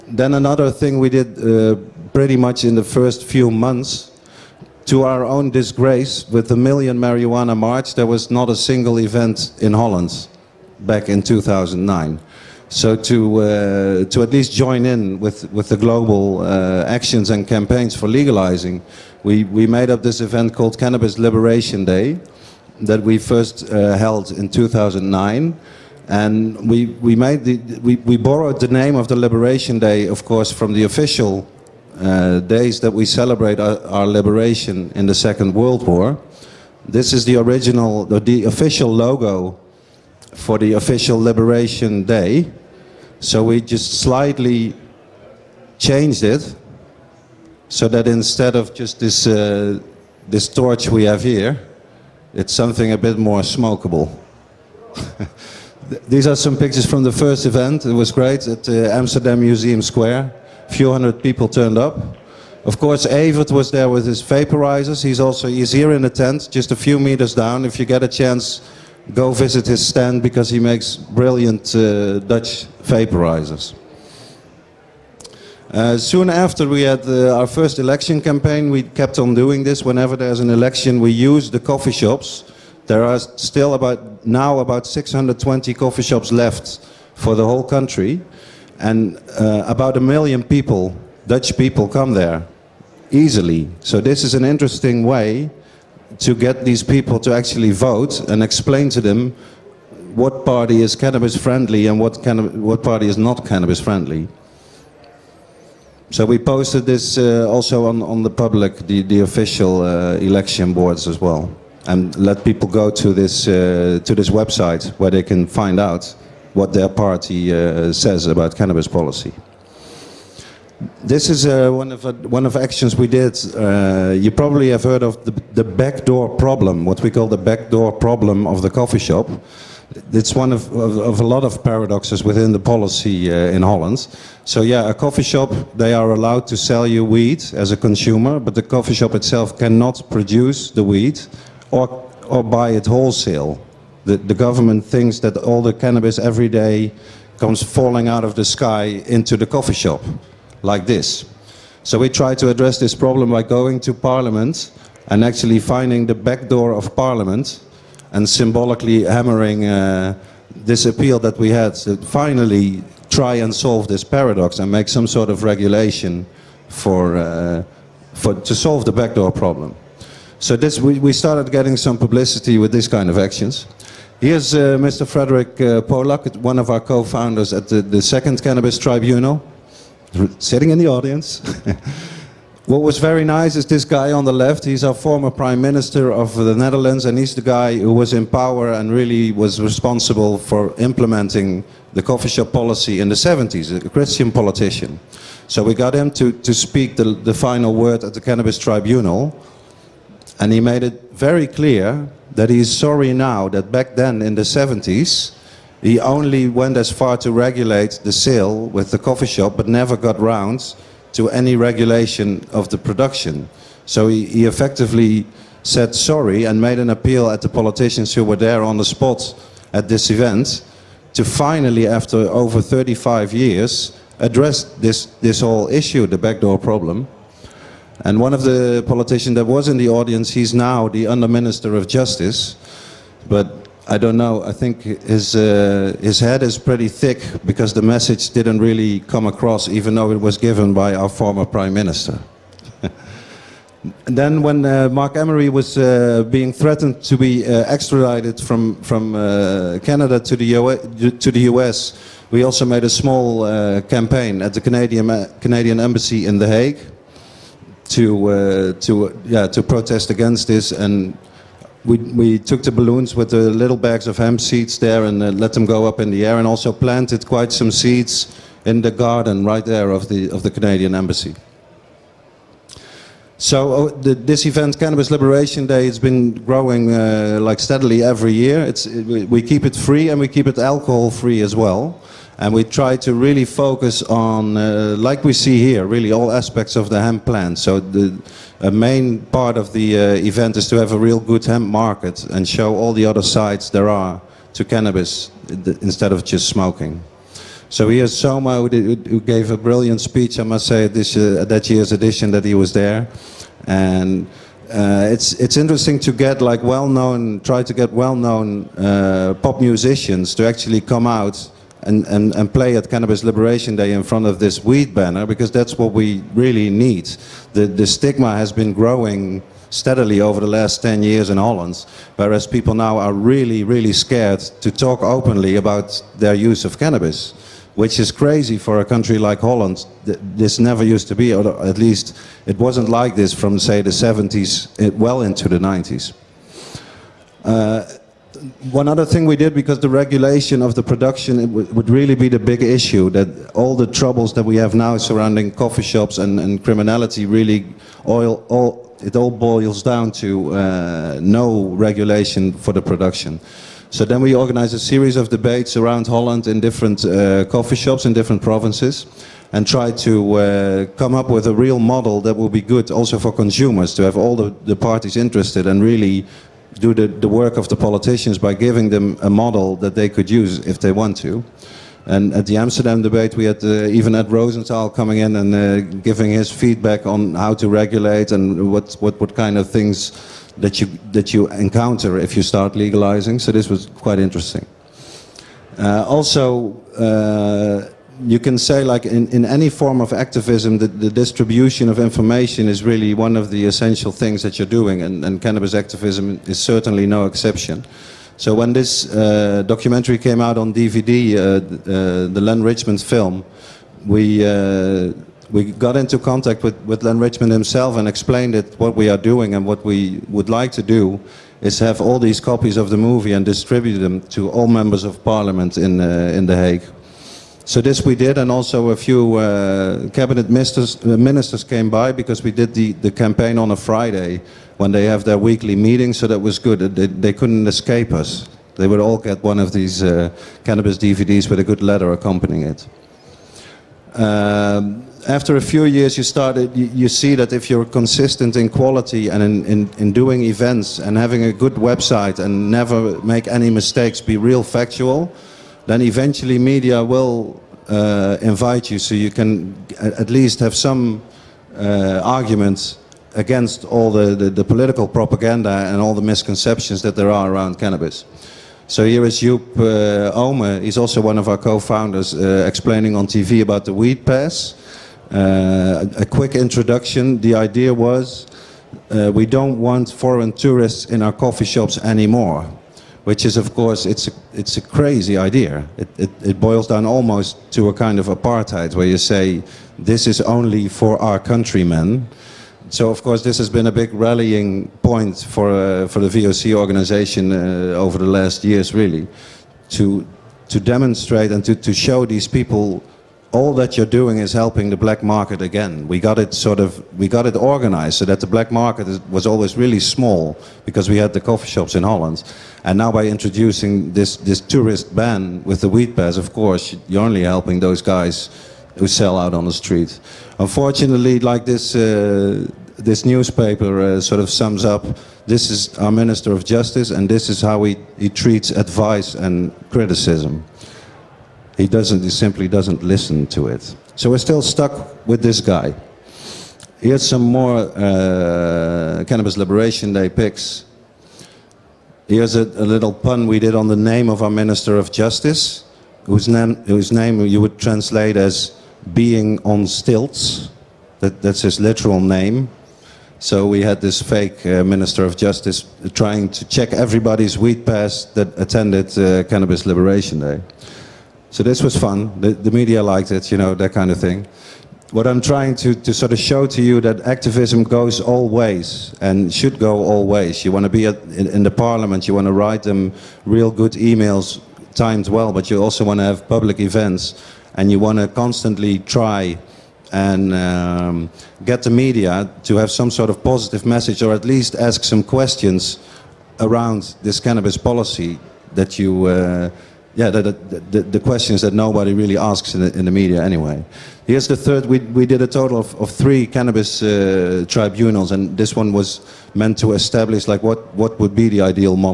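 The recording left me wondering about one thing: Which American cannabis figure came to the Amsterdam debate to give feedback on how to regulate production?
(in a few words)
Ed Rosenthal.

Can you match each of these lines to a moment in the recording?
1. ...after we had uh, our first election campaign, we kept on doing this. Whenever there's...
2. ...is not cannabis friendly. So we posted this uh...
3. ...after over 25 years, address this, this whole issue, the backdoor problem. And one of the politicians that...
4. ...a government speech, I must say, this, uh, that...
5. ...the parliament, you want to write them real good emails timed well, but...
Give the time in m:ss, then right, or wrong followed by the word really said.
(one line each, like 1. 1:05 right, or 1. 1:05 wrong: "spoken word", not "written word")
1. 1:16 right
2. 1:43 right
3. 3:41 wrong: "35", not "25"
4. 4:59 wrong: "brilliant", not "government"
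5. 9:21 right.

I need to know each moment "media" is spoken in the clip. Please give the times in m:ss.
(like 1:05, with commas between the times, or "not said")
7:26, 9:12, 9:31, 9:43.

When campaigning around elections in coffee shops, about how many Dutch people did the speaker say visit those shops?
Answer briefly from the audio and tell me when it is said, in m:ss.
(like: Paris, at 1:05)
a million, at 1:29.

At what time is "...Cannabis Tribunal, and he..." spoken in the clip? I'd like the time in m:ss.
3:18.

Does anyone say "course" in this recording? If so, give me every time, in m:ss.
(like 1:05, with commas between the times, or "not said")
0:30, 1:02, 7:53, 8:03, 8:26.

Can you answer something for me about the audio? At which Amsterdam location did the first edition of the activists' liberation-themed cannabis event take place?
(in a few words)
Museum Square.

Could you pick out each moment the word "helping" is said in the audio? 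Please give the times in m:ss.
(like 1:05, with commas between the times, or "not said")
8:14, 8:27.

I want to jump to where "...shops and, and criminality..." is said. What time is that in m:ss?
5:45.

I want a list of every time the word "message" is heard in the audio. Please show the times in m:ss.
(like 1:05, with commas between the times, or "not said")
3:57, 9:33.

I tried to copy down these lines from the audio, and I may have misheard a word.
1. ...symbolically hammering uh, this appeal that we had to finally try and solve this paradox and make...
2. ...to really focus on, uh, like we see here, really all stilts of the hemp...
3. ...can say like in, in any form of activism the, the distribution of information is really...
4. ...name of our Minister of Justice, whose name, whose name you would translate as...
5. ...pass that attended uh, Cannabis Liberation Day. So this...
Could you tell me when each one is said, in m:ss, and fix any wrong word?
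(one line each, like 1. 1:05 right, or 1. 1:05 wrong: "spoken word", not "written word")
1. 2:38 right
2. 4:42 wrong: "aspects", not "stilts"
3. 6:28 right
4. 8:53 right
5. 9:07 right.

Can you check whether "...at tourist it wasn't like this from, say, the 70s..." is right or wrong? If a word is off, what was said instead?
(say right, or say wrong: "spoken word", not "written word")
wrong: "least", not "tourist".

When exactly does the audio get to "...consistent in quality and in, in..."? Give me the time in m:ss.
7:17.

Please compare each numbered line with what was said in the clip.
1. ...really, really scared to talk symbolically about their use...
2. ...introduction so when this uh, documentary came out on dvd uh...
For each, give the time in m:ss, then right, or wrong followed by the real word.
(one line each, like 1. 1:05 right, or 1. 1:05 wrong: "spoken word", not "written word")
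1. 5:23 wrong: "openly", not "symbolically"
2. 6:37 wrong: "exception", not "introduction".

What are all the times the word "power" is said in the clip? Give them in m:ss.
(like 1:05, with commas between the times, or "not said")
3:08.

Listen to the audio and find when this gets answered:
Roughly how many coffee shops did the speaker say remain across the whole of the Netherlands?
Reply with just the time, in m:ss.
1:24.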